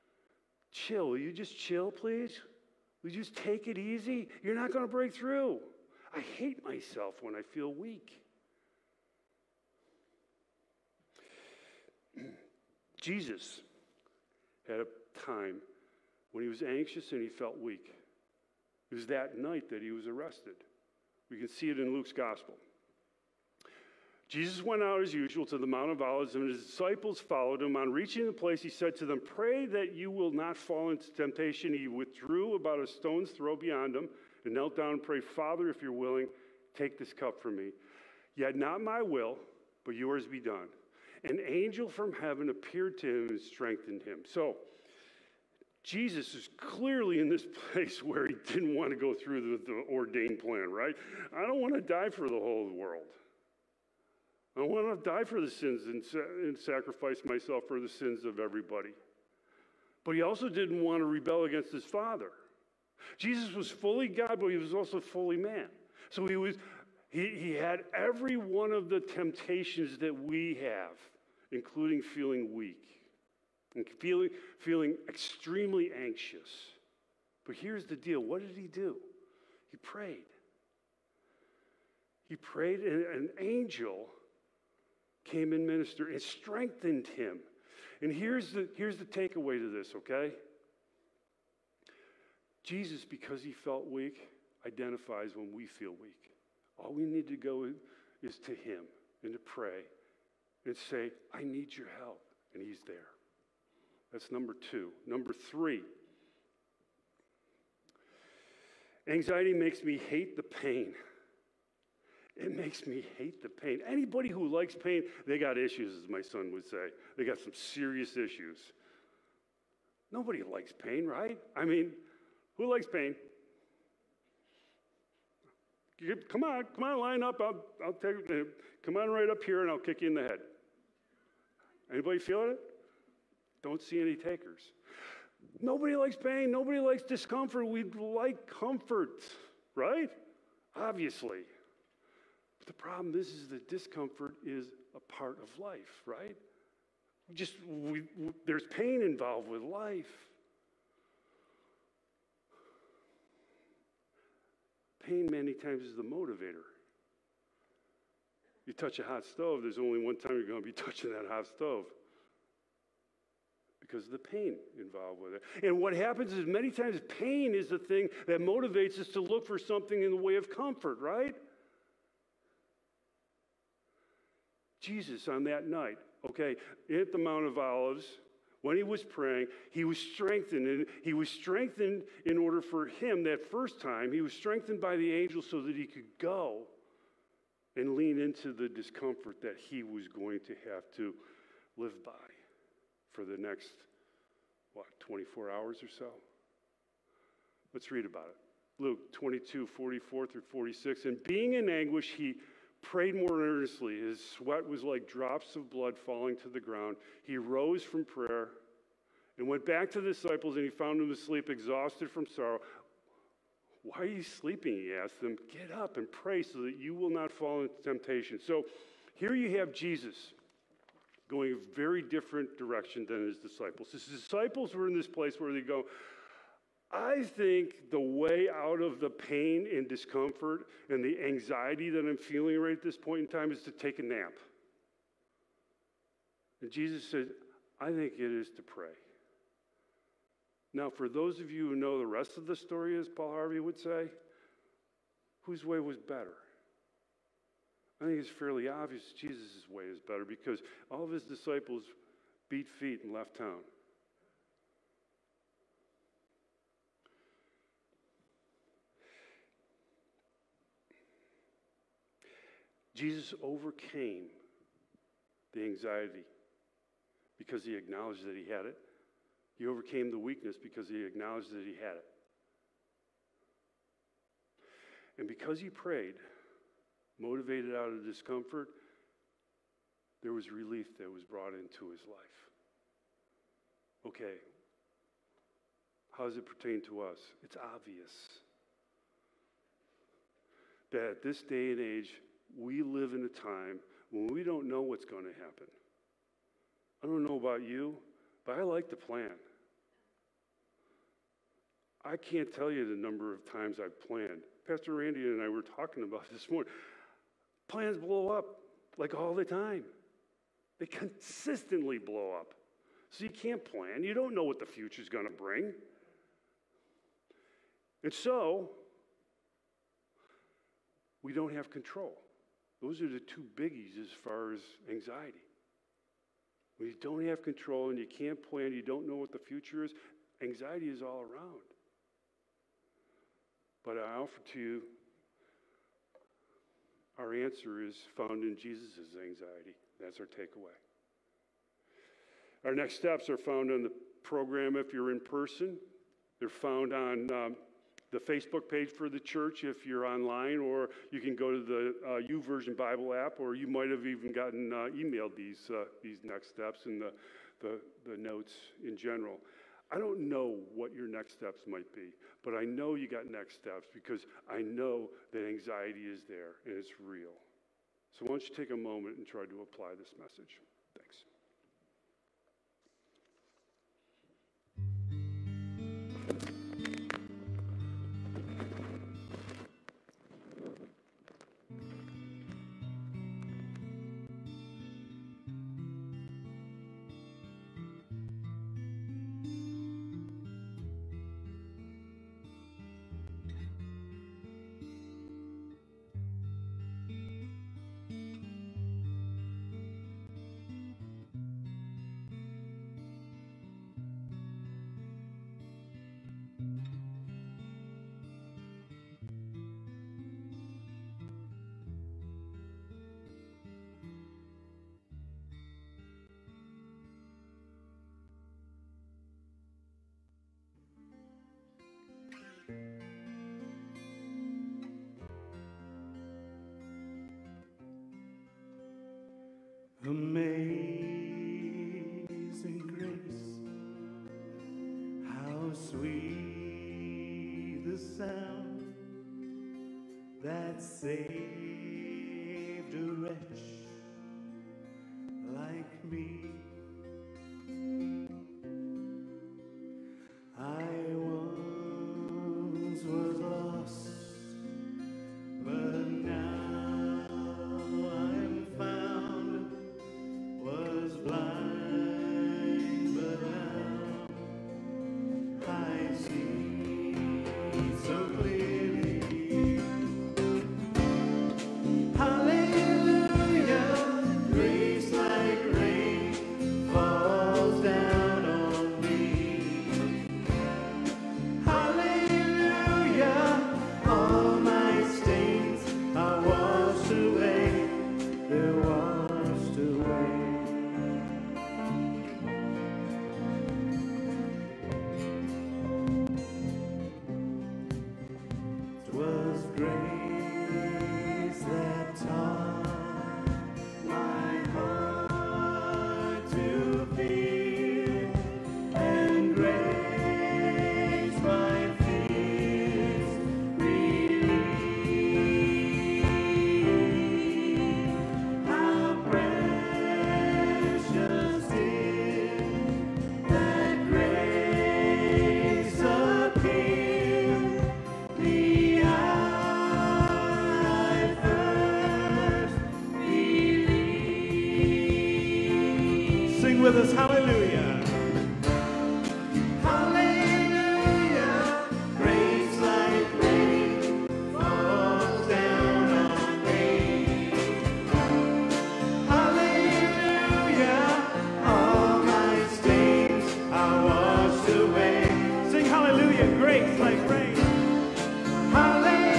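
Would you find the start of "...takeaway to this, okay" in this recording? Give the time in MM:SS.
01:29.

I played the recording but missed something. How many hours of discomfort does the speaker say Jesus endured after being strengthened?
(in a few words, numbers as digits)
24.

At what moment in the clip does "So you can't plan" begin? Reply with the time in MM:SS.
05:13.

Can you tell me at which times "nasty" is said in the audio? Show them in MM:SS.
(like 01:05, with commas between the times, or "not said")
not said.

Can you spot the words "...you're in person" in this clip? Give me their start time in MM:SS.
05:44.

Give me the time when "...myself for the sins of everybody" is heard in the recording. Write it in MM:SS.
00:57.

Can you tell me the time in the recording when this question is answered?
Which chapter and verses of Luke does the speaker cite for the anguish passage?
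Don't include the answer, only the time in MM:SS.
03:18.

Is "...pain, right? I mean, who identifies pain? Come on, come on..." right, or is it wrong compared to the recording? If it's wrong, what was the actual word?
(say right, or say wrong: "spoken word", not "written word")
wrong: "likes", not "identifies".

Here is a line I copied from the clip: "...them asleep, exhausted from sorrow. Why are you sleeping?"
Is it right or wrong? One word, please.
right.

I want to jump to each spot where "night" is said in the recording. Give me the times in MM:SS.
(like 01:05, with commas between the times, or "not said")
00:19, 02:55.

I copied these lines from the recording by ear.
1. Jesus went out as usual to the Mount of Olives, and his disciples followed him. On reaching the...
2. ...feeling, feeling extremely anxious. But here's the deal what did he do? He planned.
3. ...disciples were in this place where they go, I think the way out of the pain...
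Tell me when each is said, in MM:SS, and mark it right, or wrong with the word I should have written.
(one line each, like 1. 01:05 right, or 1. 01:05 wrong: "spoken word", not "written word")
1. 00:24 right
2. 01:13 wrong: "prayed", not "planned"
3. 03:44 right.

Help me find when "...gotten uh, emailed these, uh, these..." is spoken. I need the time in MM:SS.
05:54.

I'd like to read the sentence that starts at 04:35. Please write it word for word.
And because he prayed, motivated out of discomfort, there was relief that was brought into his life.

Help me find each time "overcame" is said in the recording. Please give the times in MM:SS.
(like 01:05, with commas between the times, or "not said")
04:23, 04:29.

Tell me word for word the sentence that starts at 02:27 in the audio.
Just we, we, there's pain involved with life.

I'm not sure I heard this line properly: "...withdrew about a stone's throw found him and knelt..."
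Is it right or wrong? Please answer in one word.
wrong.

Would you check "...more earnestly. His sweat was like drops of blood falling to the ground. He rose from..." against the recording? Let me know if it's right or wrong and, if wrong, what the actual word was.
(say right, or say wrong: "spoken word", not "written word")
right.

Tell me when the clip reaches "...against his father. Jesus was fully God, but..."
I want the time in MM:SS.
01:01.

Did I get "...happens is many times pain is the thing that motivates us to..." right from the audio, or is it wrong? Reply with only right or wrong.
right.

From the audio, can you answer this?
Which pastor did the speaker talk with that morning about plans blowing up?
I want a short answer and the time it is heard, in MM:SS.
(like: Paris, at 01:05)
Pastor Randy, at 05:04.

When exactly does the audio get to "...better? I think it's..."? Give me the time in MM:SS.
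04:05.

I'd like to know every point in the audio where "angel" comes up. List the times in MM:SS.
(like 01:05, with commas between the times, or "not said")
00:41, 01:23, 03:05.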